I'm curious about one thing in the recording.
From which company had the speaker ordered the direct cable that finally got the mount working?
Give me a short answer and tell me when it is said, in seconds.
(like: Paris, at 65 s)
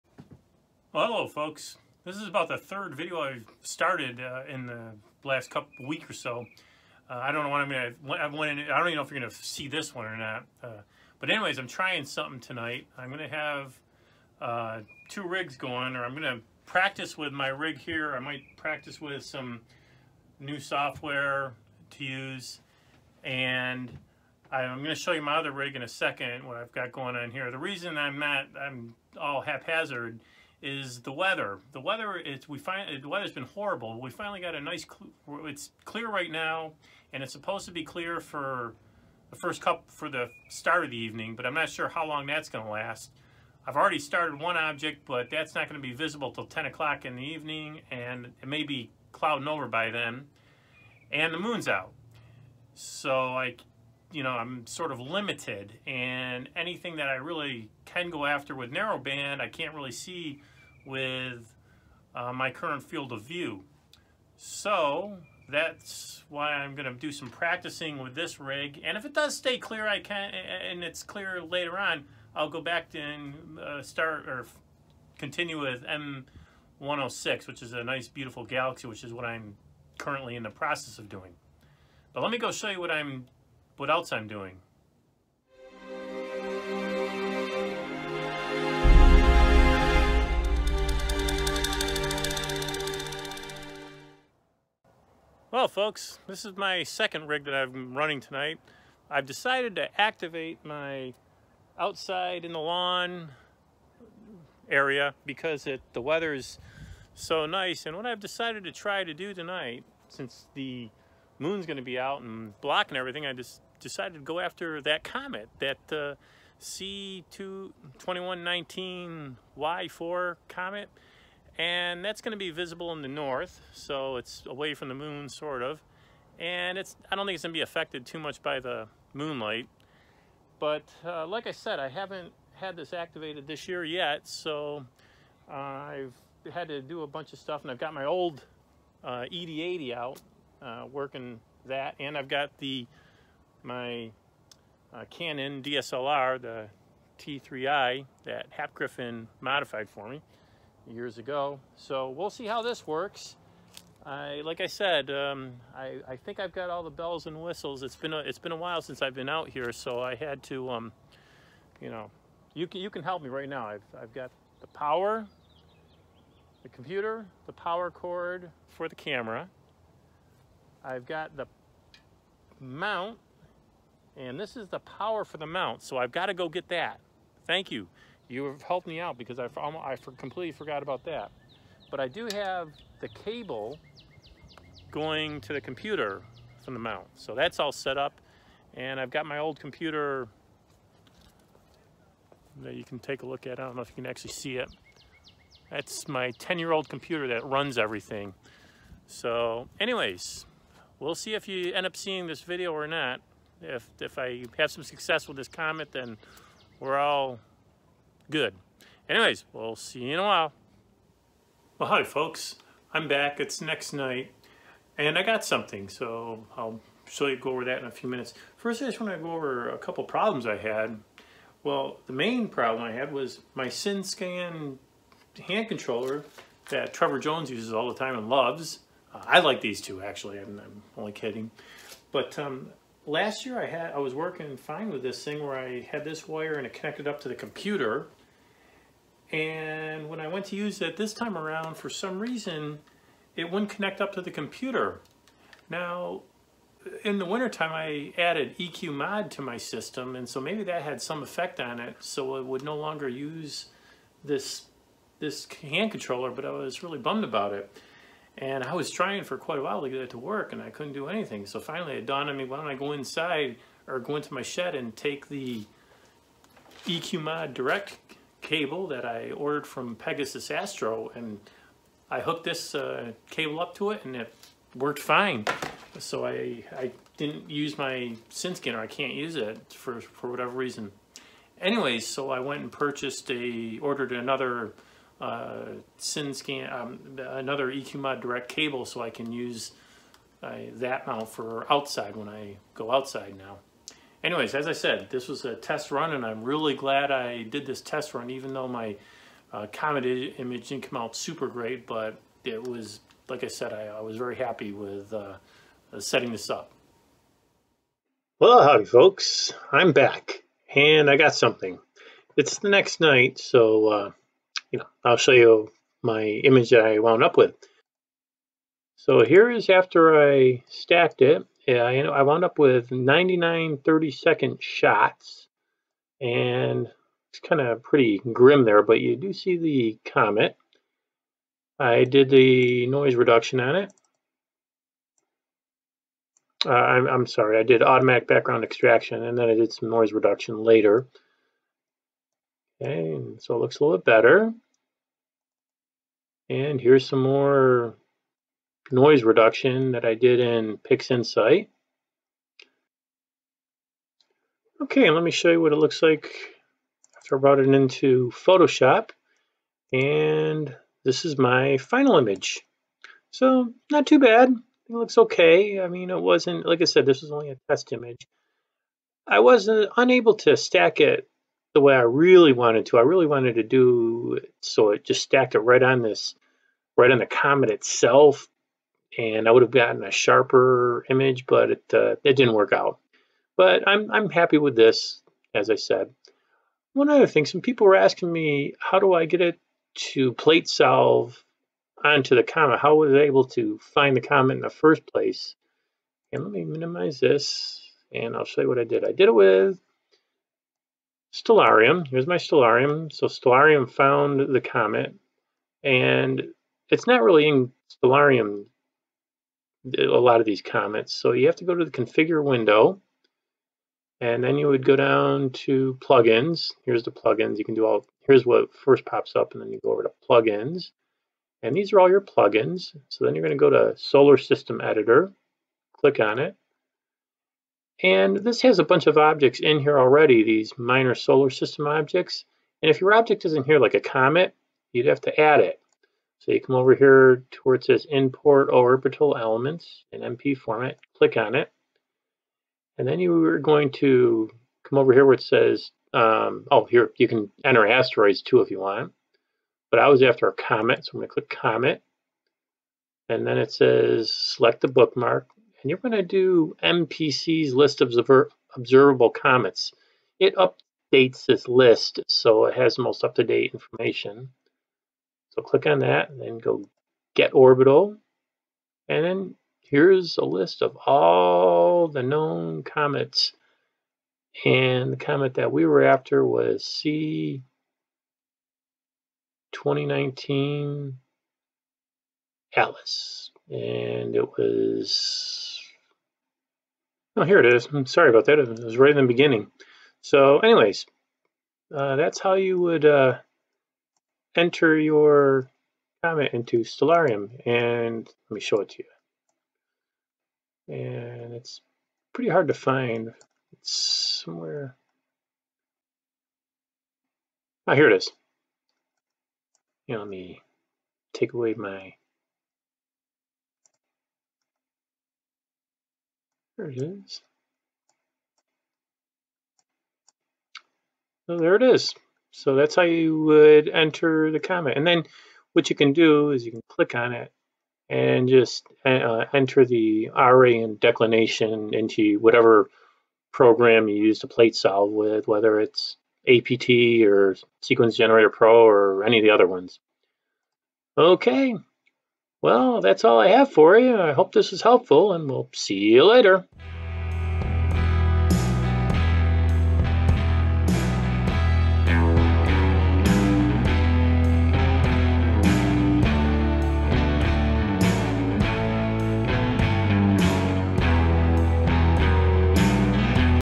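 Pegasus Astro, at 269 s.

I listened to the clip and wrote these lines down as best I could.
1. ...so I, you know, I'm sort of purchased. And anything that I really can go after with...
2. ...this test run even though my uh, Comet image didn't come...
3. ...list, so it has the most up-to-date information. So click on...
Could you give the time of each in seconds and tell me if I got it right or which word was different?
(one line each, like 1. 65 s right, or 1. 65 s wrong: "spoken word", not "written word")
1. 52 s wrong: "limited", not "purchased"
2. 297 s right
3. 461 s right.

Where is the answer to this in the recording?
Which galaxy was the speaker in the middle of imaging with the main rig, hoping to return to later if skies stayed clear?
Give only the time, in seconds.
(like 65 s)
76 s.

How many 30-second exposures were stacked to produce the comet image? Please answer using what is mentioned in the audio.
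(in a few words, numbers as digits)
99.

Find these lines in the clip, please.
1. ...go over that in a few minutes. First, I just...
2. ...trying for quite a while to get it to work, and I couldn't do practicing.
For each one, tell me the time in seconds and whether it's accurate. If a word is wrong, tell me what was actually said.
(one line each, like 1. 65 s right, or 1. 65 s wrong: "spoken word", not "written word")
1. 217 s right
2. 258 s wrong: "anything", not "practicing".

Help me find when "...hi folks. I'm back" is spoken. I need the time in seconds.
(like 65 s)
211 s.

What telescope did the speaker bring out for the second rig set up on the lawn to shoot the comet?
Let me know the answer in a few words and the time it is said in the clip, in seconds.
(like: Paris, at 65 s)
ED80, at 139 s.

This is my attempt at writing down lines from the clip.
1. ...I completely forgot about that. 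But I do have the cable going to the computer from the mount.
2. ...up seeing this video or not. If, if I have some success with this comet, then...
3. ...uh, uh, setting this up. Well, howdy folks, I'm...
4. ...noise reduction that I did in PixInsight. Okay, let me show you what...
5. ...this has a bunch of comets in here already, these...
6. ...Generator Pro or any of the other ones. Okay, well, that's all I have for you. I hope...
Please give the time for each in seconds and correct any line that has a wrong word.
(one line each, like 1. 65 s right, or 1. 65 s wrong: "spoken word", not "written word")
1. 179 s right
2. 201 s right
3. 305 s right
4. 348 s right
5. 428 s wrong: "objects", not "comets"
6. 538 s right.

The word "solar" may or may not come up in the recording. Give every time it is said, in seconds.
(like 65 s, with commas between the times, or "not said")
423 s, 431 s.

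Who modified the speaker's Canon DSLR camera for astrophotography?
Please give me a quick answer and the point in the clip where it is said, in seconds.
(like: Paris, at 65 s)
Hap Griffith, at 148 s.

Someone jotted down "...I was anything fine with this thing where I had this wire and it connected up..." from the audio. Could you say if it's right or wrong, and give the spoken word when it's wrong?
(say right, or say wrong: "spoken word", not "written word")
wrong: "working", not "anything".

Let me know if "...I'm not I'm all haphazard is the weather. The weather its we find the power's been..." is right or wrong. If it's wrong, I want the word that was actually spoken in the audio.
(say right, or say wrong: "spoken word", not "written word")
wrong: "weather", not "power".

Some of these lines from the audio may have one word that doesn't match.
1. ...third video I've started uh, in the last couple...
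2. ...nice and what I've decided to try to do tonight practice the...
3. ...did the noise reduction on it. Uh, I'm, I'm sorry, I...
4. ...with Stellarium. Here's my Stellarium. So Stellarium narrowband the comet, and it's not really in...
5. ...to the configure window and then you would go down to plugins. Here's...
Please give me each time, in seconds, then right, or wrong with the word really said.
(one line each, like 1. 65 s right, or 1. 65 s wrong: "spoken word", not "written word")
1. 2 s right
2. 107 s wrong: "since", not "practice"
3. 332 s right
4. 399 s wrong: "found", not "narrowband"
5. 411 s right.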